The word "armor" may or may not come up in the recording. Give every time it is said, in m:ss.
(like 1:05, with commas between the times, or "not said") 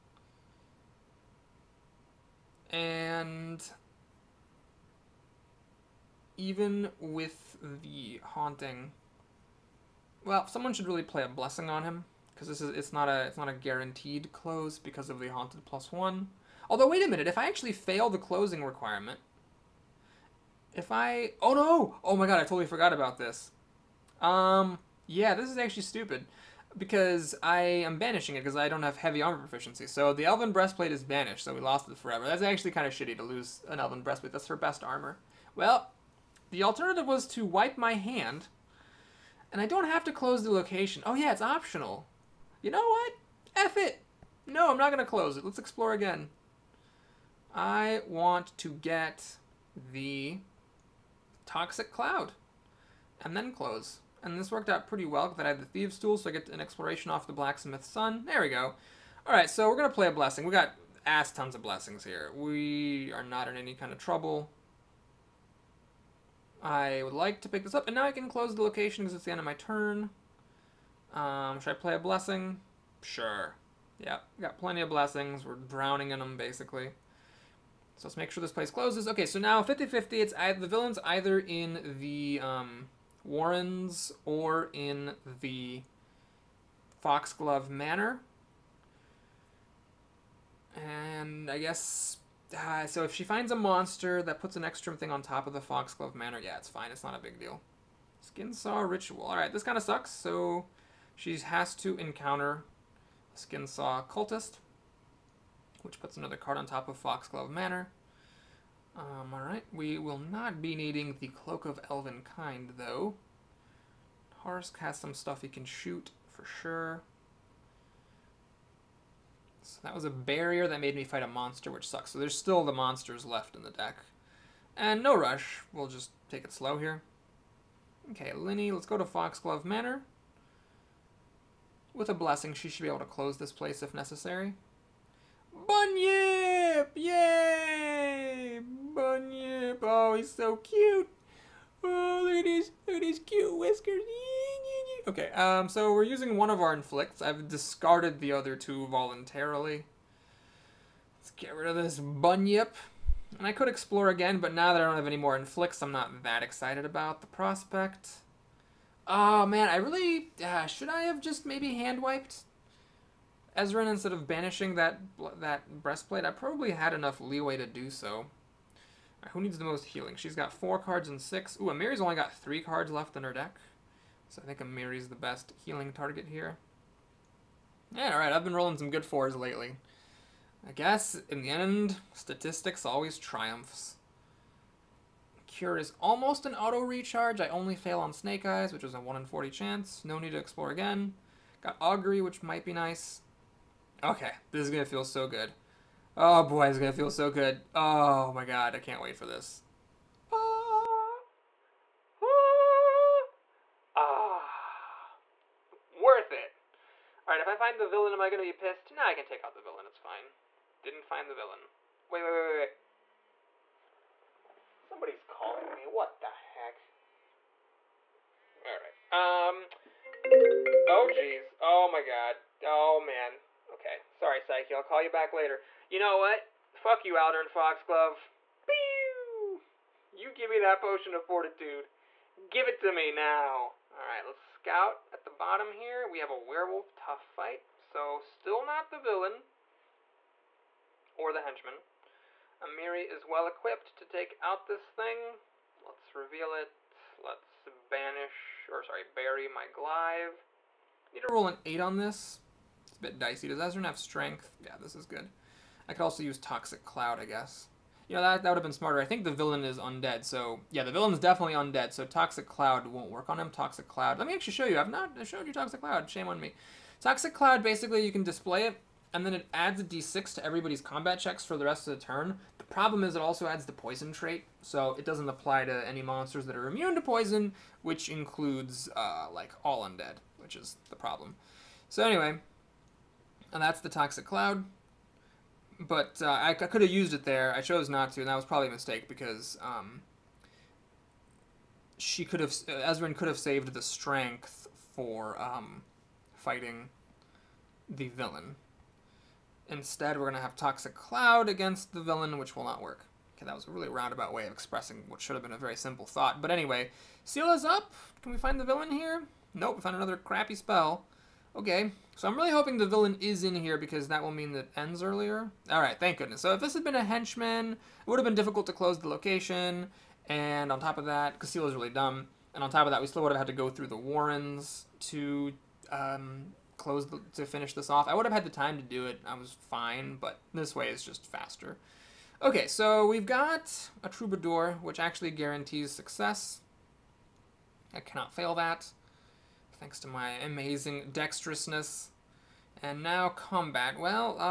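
0:29, 0:34.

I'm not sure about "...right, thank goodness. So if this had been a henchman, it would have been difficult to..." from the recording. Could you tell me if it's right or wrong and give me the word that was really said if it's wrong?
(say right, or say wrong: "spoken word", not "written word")
right.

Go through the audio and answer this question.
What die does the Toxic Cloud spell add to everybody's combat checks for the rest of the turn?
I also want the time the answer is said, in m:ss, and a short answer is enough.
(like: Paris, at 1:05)
d6, at 4:29.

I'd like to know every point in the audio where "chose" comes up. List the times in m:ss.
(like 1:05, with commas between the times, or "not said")
4:47.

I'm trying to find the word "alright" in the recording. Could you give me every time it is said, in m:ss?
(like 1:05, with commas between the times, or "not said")
1:49, 2:58.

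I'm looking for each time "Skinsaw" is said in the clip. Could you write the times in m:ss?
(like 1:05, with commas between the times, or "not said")
1:38, 1:43.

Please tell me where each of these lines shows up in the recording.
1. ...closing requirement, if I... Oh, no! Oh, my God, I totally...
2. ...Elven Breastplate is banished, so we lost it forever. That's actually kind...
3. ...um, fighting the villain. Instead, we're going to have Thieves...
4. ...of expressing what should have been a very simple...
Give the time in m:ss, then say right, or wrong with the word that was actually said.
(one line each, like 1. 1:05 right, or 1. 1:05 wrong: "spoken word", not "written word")
1. 0:18 right
2. 0:30 right
3. 4:55 wrong: "Toxic", not "Thieves"
4. 5:04 right.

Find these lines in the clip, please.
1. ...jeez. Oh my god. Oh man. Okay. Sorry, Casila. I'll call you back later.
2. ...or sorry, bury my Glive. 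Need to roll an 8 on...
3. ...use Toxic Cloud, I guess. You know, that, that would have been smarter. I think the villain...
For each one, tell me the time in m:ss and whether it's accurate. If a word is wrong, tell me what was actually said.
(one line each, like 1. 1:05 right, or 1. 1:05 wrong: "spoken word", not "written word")
1. 3:41 wrong: "Psyche", not "Casila"
2. 4:08 right
3. 4:16 right.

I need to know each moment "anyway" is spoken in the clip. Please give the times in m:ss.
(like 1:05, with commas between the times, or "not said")
4:42, 5:06.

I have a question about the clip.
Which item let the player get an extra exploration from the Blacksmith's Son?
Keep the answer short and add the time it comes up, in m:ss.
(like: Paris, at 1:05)
Thieves tool, at 0:55.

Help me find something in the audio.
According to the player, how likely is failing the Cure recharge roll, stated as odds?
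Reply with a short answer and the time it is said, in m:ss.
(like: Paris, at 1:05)
1 in 40, at 3:08.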